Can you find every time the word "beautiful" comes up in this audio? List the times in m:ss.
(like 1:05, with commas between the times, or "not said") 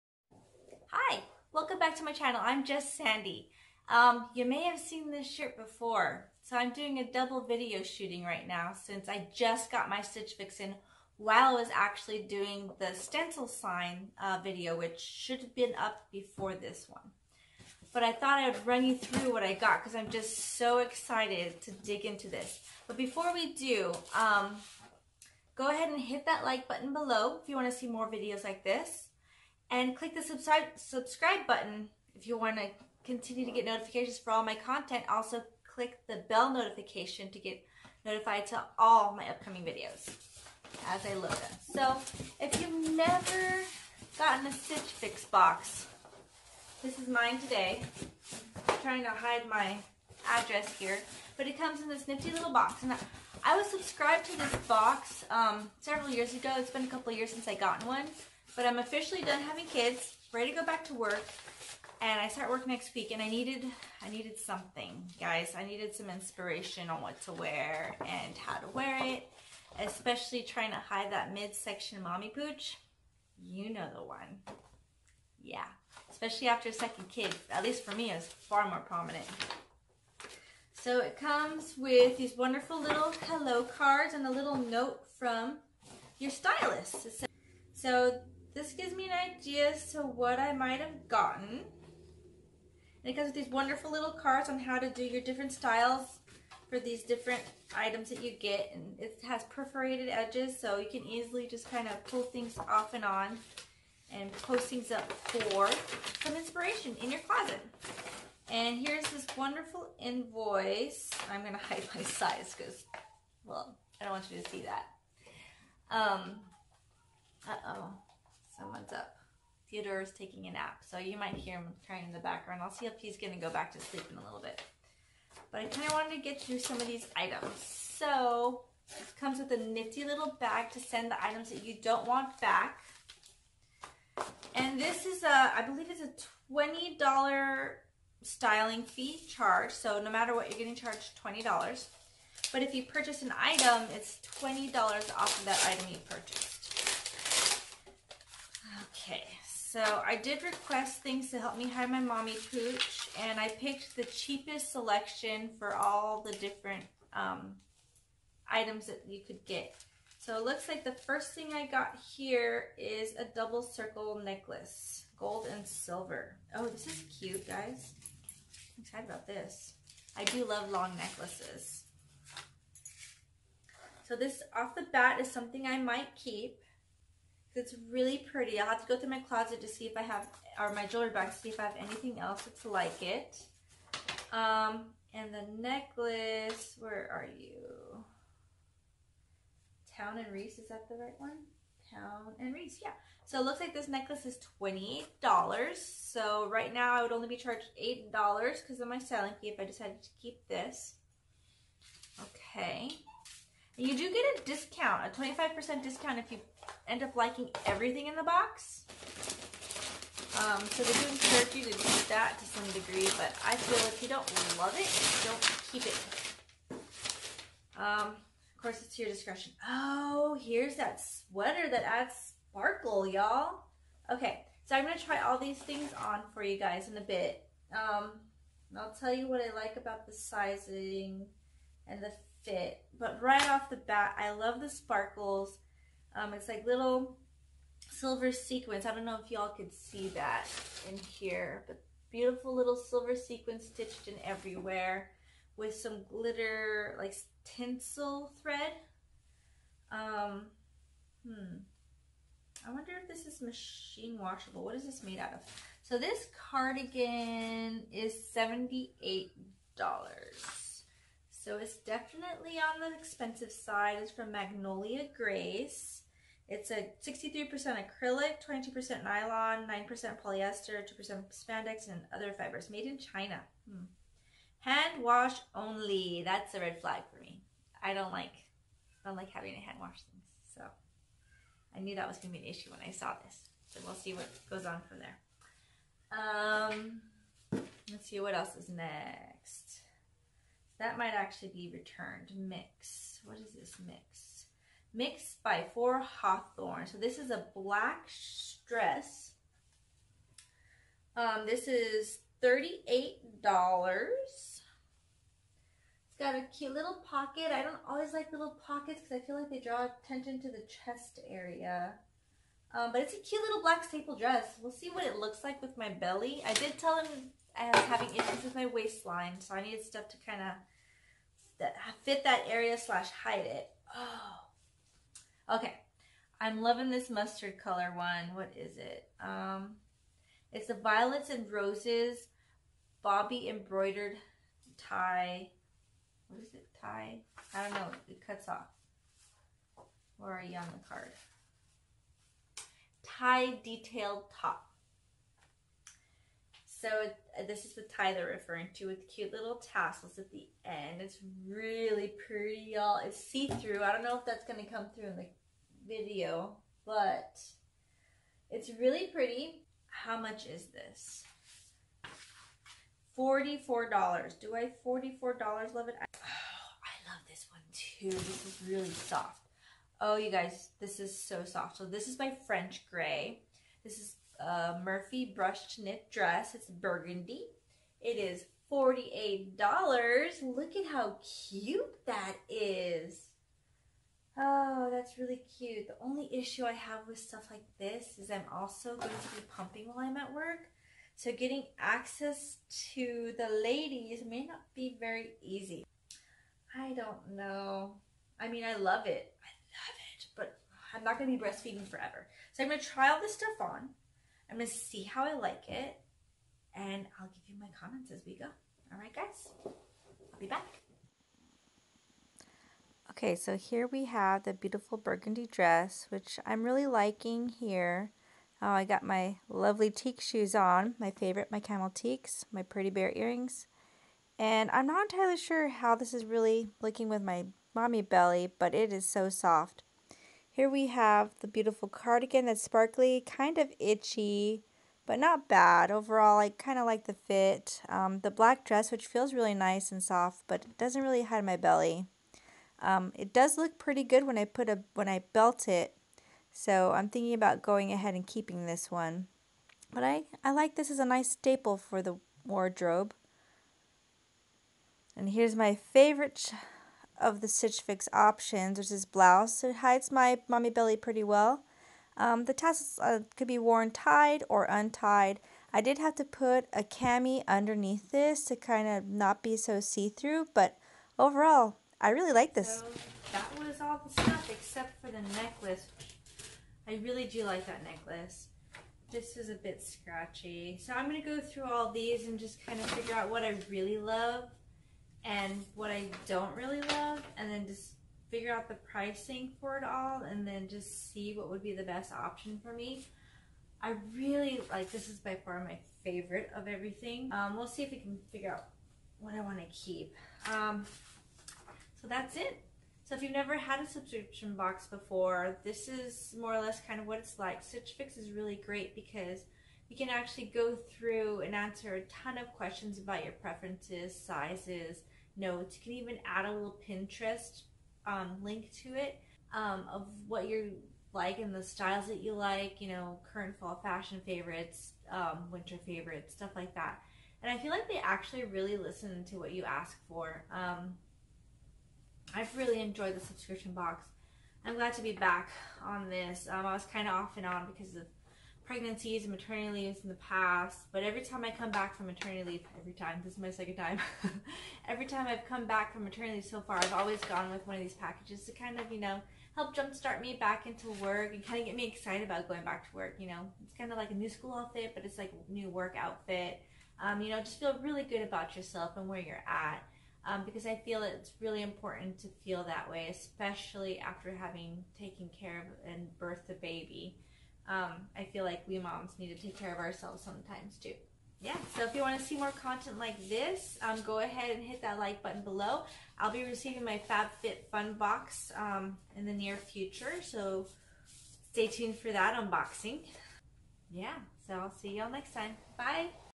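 4:02, 6:54, 7:11.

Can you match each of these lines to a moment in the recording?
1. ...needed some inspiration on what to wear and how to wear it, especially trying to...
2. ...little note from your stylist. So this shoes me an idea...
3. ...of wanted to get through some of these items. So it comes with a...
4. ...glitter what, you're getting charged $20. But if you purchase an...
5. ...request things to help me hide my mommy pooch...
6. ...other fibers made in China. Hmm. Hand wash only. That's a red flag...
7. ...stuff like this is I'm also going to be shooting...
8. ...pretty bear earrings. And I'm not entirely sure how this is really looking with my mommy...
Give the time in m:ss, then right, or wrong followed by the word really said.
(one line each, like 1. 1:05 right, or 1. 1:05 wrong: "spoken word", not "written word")
1. 1:05 right
2. 1:24 wrong: "gives", not "shoes"
3. 2:05 right
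4. 2:20 wrong: "matter", not "glitter"
5. 2:30 right
6. 4:32 right
7. 6:27 wrong: "pumping", not "shooting"
8. 7:02 right.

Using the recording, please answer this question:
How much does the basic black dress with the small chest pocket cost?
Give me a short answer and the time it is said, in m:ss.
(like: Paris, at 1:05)
$38, at 5:02.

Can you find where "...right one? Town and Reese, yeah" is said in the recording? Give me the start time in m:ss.
3:10.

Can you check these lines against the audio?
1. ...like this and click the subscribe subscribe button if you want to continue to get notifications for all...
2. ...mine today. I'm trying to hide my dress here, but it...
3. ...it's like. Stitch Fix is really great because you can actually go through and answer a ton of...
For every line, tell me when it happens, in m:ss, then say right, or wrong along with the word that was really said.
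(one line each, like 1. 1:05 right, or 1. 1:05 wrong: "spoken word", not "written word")
1. 0:28 right
2. 0:47 wrong: "address", not "dress"
3. 8:27 right.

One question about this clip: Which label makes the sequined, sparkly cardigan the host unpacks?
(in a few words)
Magnolia Grace.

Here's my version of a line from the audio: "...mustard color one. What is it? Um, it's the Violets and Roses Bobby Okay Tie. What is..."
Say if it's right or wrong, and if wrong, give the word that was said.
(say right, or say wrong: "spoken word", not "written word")
wrong: "Embroidered", not "Okay".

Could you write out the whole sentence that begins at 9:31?
Yeah, so if you want to see more content like this, um, go ahead and hit that like button below.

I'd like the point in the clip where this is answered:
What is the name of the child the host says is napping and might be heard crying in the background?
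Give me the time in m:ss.
1:59.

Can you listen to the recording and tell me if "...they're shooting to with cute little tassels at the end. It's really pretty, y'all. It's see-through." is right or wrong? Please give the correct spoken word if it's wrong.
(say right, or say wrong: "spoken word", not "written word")
wrong: "referring", not "shooting".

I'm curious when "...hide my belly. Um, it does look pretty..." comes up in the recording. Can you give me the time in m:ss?
7:21.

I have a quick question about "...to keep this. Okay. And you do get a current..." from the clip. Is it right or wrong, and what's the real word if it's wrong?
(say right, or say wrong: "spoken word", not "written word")
wrong: "discount", not "current".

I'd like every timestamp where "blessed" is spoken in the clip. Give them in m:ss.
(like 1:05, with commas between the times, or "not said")
not said.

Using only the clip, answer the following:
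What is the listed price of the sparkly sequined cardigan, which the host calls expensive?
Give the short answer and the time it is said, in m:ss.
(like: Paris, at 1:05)
$78, at 4:18.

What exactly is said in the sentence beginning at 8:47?
And I feel like they actually really listen to what you ask for.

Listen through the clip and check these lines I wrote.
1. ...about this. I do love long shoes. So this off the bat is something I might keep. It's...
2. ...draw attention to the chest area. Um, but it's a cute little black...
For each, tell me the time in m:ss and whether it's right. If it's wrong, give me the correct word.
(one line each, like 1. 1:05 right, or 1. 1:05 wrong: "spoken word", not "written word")
1. 2:49 wrong: "necklaces", not "shoes"
2. 5:09 right.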